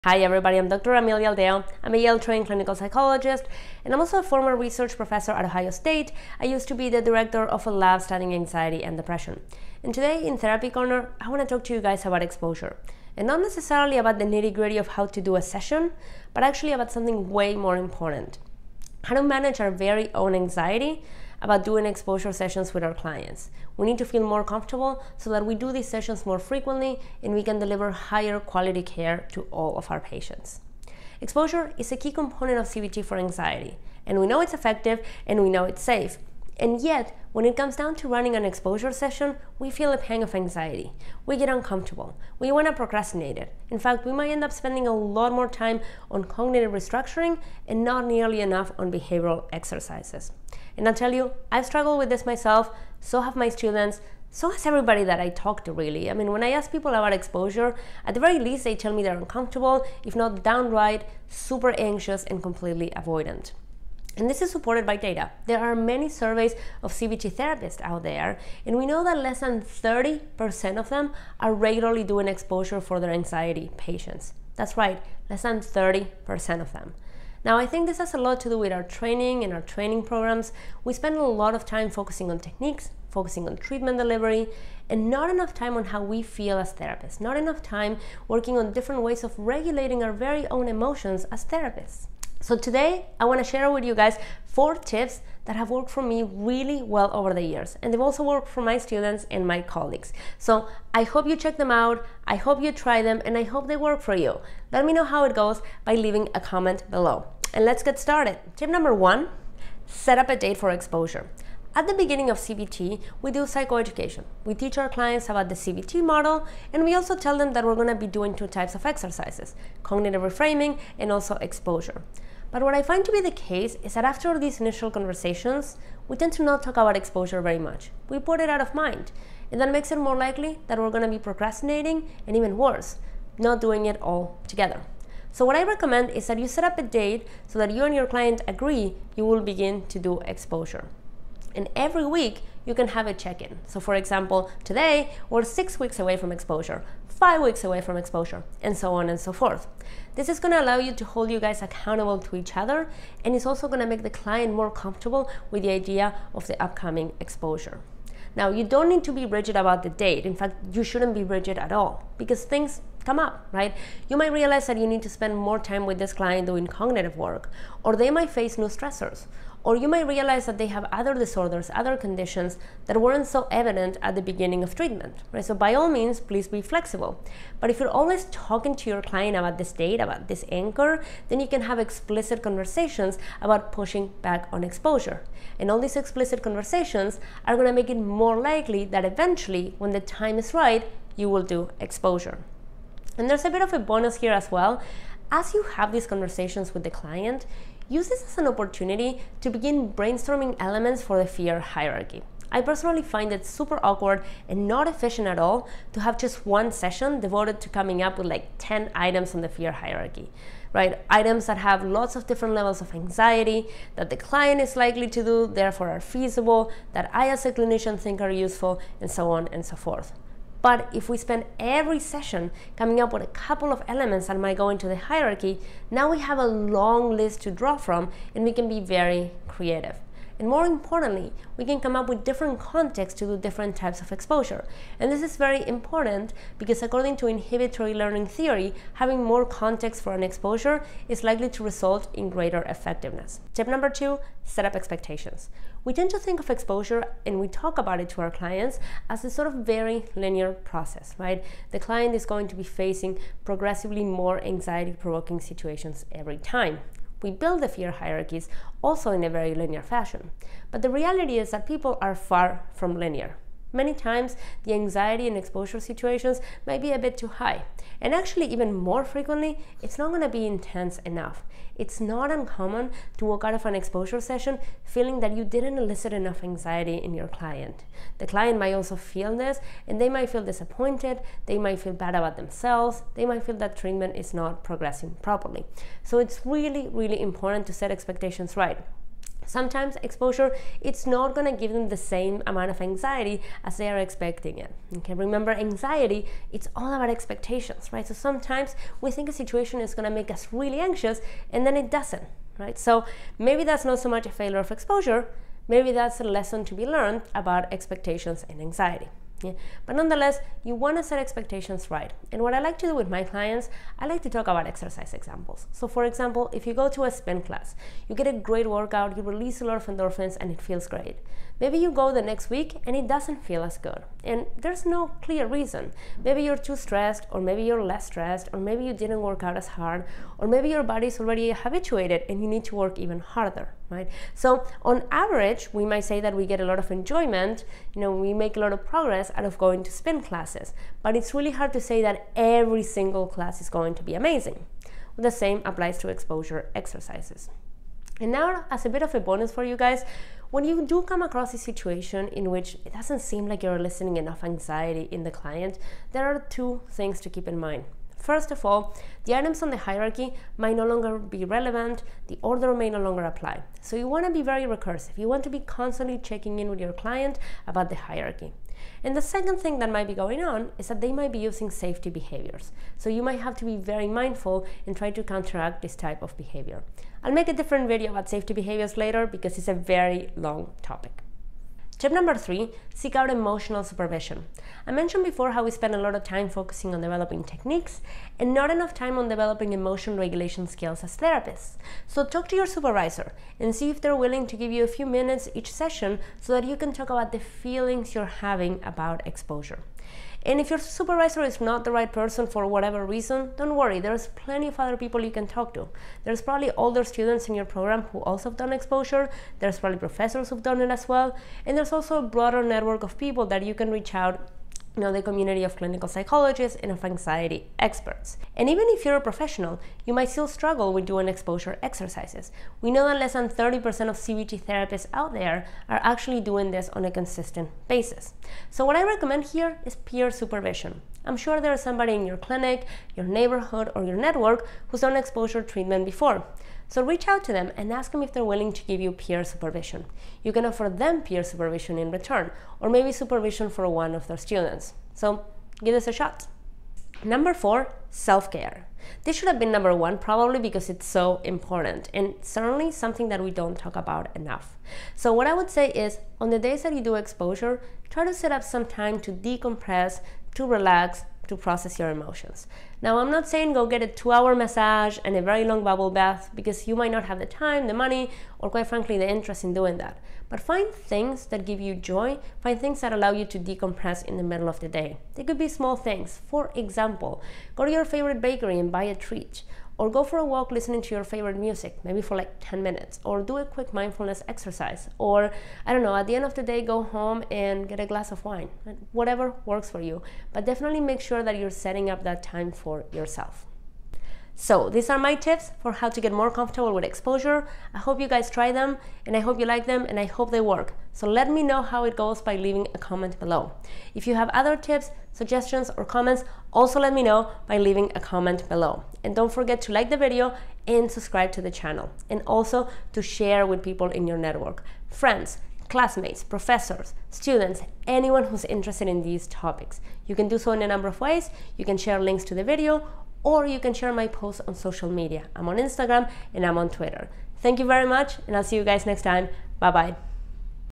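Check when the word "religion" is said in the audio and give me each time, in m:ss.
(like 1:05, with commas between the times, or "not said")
not said.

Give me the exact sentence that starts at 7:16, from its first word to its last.
So reach out to them and ask them if they're willing to give you peer supervision.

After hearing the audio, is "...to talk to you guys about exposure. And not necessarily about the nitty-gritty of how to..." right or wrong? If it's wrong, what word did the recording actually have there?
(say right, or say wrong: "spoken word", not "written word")
right.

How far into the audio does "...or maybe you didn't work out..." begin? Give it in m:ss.
5:28.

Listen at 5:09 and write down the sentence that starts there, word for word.
But nonetheless, you want to set expectations right.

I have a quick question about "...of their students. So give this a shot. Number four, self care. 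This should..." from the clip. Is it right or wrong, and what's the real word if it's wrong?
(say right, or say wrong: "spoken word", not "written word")
right.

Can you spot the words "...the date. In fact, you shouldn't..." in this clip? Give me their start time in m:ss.
2:39.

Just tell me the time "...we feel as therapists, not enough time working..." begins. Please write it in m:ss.
1:26.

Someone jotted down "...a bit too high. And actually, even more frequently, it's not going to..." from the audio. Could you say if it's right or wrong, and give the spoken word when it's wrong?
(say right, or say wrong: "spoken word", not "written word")
right.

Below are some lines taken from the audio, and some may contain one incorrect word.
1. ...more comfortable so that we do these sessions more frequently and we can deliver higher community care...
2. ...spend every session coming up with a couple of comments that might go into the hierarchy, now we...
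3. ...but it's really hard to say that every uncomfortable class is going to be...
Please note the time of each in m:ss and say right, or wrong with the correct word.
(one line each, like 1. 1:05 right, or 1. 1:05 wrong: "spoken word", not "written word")
1. 0:24 wrong: "quality", not "community"
2. 3:41 wrong: "elements", not "comments"
3. 5:41 wrong: "single", not "uncomfortable".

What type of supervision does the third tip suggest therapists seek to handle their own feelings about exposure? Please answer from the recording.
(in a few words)
emotional supervision.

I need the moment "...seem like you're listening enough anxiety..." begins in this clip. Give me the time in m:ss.
5:53.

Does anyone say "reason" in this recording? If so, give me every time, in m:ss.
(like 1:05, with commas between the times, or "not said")
5:25, 6:43.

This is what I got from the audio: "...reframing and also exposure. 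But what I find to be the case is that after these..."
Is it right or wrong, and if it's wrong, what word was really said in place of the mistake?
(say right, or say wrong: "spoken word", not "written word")
right.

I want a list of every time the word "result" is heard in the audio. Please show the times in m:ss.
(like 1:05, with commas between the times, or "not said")
4:01.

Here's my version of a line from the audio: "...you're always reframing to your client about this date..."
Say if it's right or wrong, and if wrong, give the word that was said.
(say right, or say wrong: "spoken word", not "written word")
wrong: "talking", not "reframing".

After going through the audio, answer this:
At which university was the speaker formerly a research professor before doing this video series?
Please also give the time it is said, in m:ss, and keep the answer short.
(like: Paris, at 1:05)
Ohio State, at 0:05.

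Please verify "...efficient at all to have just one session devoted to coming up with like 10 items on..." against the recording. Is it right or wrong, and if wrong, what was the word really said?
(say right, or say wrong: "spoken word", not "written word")
right.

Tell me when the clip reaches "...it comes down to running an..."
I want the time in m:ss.
0:37.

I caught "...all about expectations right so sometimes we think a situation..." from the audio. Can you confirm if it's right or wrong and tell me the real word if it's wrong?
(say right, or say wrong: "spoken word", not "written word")
right.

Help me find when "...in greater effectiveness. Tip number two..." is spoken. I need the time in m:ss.
4:02.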